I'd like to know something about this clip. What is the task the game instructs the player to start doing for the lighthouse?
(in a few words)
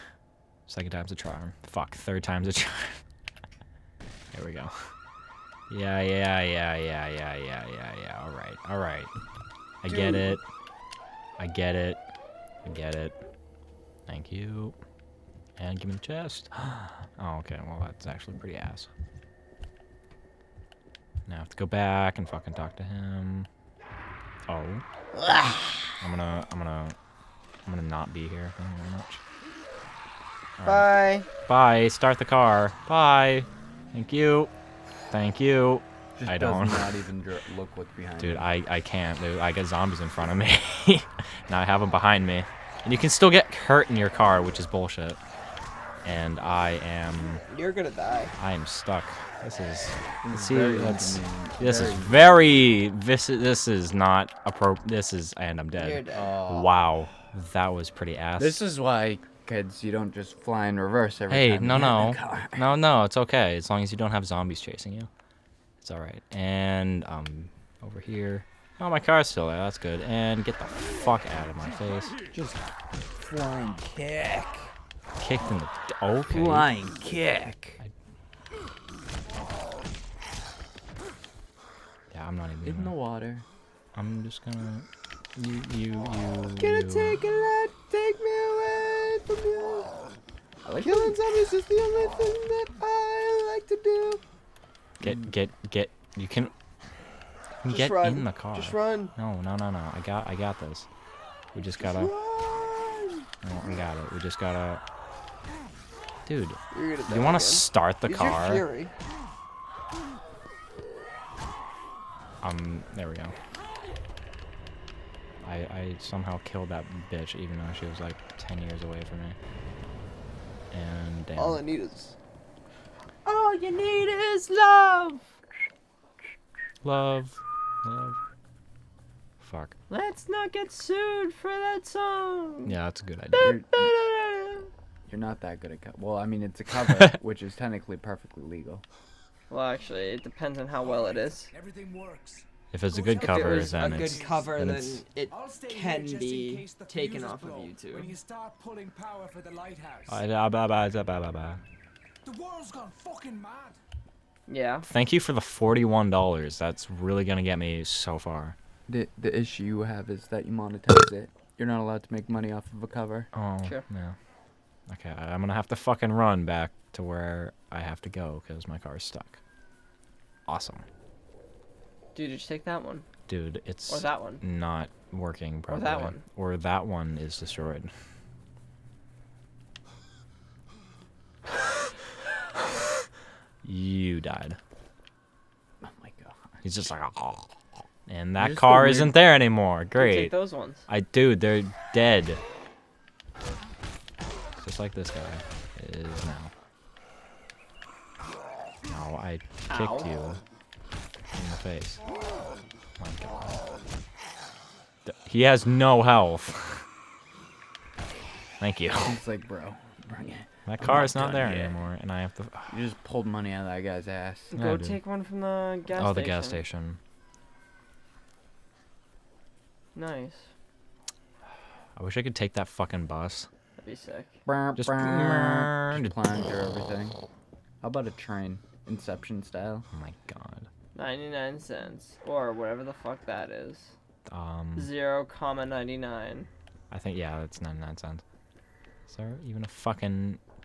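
pulling power.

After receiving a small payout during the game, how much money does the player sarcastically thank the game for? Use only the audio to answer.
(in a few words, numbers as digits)
$41.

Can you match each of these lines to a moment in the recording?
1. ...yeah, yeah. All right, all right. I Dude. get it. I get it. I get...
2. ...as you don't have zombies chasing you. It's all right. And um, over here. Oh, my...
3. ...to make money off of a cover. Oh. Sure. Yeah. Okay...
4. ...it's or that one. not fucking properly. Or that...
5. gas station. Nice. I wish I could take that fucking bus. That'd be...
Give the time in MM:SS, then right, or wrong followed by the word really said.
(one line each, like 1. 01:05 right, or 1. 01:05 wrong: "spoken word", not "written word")
1. 00:07 right
2. 01:03 right
3. 02:42 right
4. 02:53 wrong: "working", not "fucking"
5. 03:36 right.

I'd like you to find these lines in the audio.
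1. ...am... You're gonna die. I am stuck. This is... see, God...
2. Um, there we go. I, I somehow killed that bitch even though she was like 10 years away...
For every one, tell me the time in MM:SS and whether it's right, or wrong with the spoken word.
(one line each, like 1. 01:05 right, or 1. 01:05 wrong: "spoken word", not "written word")
1. 00:46 wrong: "This", not "God"
2. 01:52 right.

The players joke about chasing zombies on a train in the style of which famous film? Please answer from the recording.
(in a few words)
Inception.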